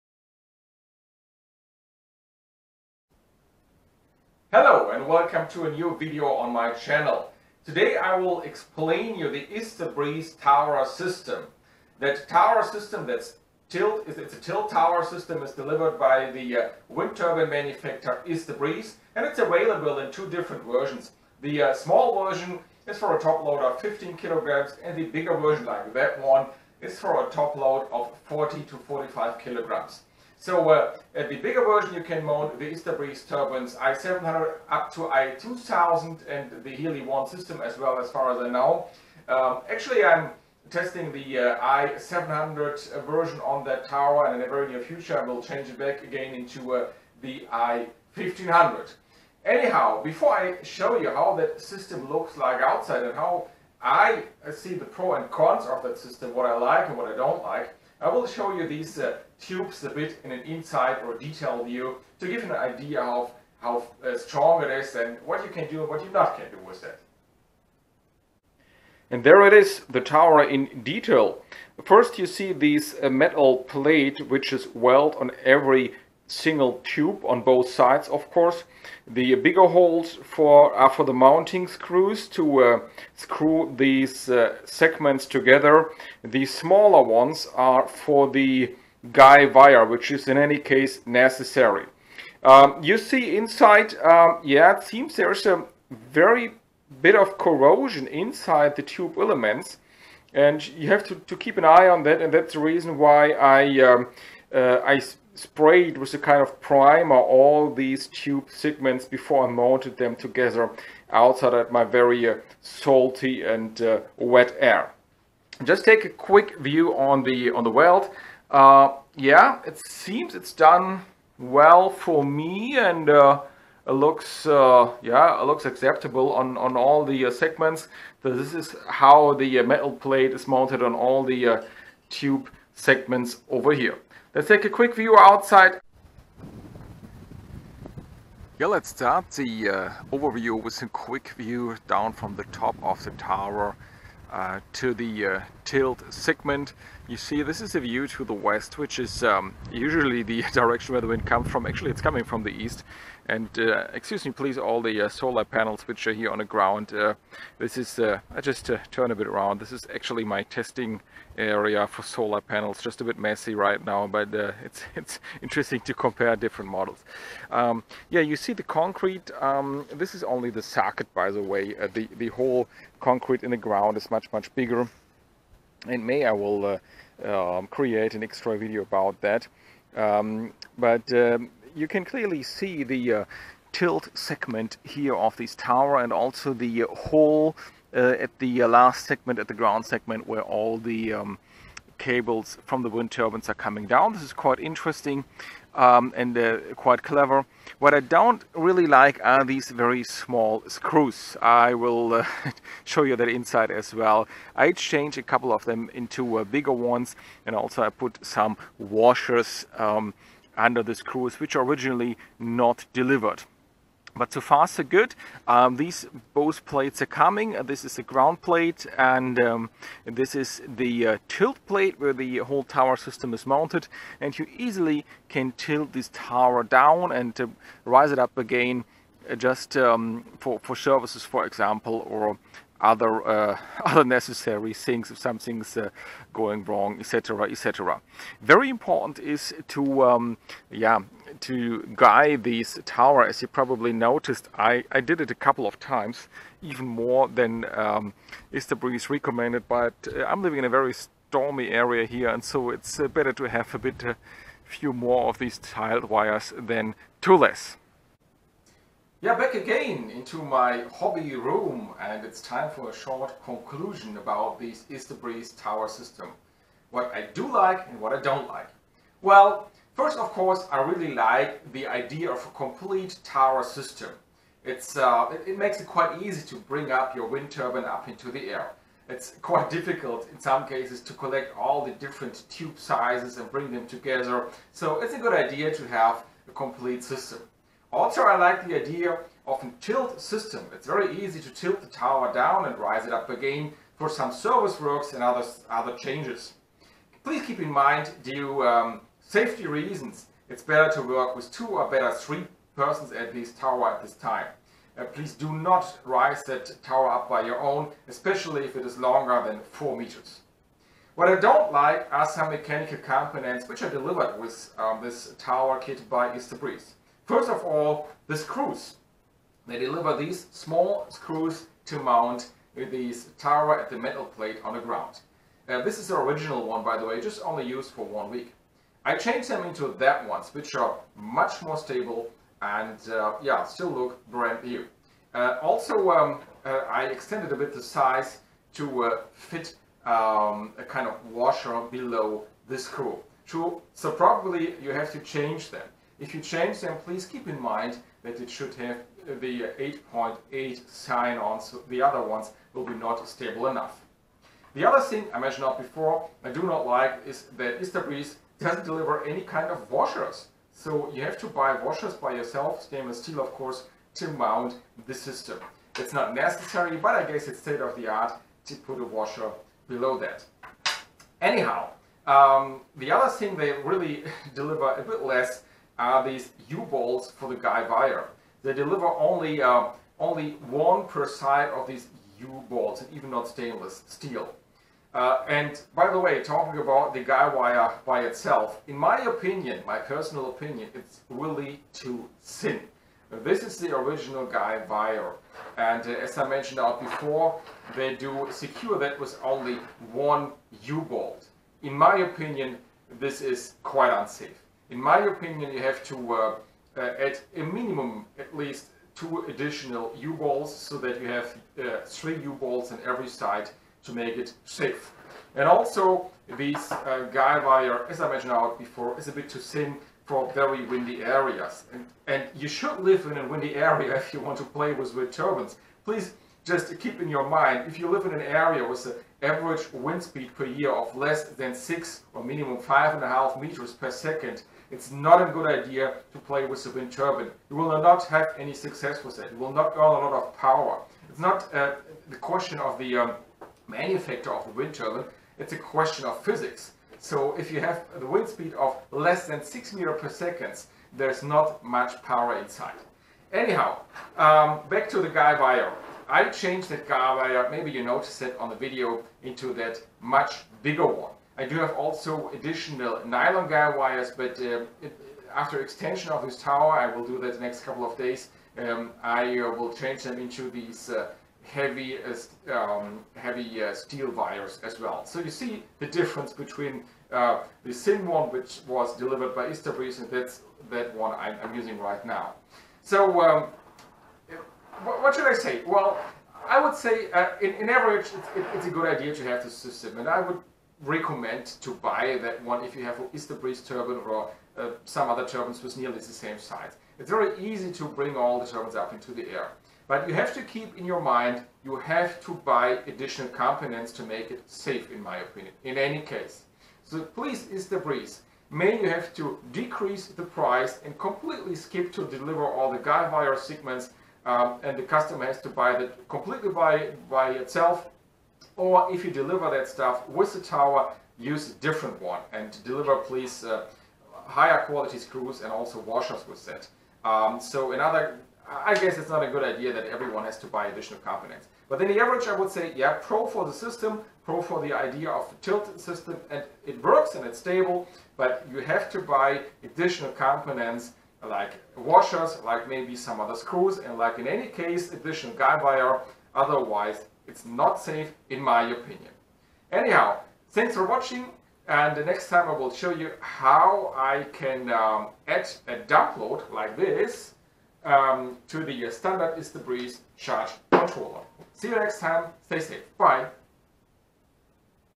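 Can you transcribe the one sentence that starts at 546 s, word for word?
Otherwise, it's not safe in my opinion.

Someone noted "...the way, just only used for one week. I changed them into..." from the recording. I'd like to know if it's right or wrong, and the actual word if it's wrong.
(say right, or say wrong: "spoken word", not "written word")
right.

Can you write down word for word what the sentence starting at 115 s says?
Just take a quick view on the on the weld.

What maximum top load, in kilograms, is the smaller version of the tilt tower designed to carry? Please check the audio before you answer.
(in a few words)
15 kilograms.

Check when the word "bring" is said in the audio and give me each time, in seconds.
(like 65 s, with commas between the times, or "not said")
276 s, 283 s, 498 s.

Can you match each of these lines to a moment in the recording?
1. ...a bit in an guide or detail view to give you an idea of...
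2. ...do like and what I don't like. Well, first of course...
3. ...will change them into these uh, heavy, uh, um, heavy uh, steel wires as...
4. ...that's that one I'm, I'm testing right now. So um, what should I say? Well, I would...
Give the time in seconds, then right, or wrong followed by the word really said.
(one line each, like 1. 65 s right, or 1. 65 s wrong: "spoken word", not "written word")
1. 59 s wrong: "inside", not "guide"
2. 267 s right
3. 469 s right
4. 480 s wrong: "using", not "testing".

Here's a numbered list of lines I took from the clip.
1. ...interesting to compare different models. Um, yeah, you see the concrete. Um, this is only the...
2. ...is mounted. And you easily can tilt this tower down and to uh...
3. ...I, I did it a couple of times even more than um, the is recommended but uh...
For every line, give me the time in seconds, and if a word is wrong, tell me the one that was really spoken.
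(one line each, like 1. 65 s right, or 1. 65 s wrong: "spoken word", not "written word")
1. 165 s right
2. 223 s right
3. 244 s right.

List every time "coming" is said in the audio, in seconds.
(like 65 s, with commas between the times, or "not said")
152 s, 193 s, 217 s.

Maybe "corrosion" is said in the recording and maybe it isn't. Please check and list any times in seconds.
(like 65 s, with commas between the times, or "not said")
97 s.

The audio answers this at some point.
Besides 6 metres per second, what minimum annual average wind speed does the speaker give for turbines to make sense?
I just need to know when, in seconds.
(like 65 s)
432 s.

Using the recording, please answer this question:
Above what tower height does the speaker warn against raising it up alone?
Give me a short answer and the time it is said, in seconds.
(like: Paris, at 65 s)
4 meters, at 309 s.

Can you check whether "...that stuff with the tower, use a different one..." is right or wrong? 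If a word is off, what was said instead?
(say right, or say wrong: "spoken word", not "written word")
right.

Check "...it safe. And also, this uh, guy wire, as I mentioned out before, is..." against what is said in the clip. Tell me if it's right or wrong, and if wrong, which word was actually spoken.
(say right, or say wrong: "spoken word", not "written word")
right.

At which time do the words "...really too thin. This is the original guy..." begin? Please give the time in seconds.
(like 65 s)
391 s.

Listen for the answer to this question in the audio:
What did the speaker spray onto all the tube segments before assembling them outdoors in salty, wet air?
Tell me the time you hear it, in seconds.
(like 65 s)
106 s.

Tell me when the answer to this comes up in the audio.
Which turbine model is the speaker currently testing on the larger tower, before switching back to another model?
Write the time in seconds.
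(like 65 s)
41 s.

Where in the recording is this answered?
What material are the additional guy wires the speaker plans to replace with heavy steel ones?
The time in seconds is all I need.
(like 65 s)
463 s.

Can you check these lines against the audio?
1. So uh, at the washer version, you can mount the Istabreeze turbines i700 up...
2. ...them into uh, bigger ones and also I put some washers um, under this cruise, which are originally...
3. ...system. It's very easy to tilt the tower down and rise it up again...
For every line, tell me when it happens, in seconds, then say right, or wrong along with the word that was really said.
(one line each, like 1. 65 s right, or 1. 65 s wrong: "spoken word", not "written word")
1. 30 s wrong: "bigger", not "washer"
2. 205 s right
3. 290 s right.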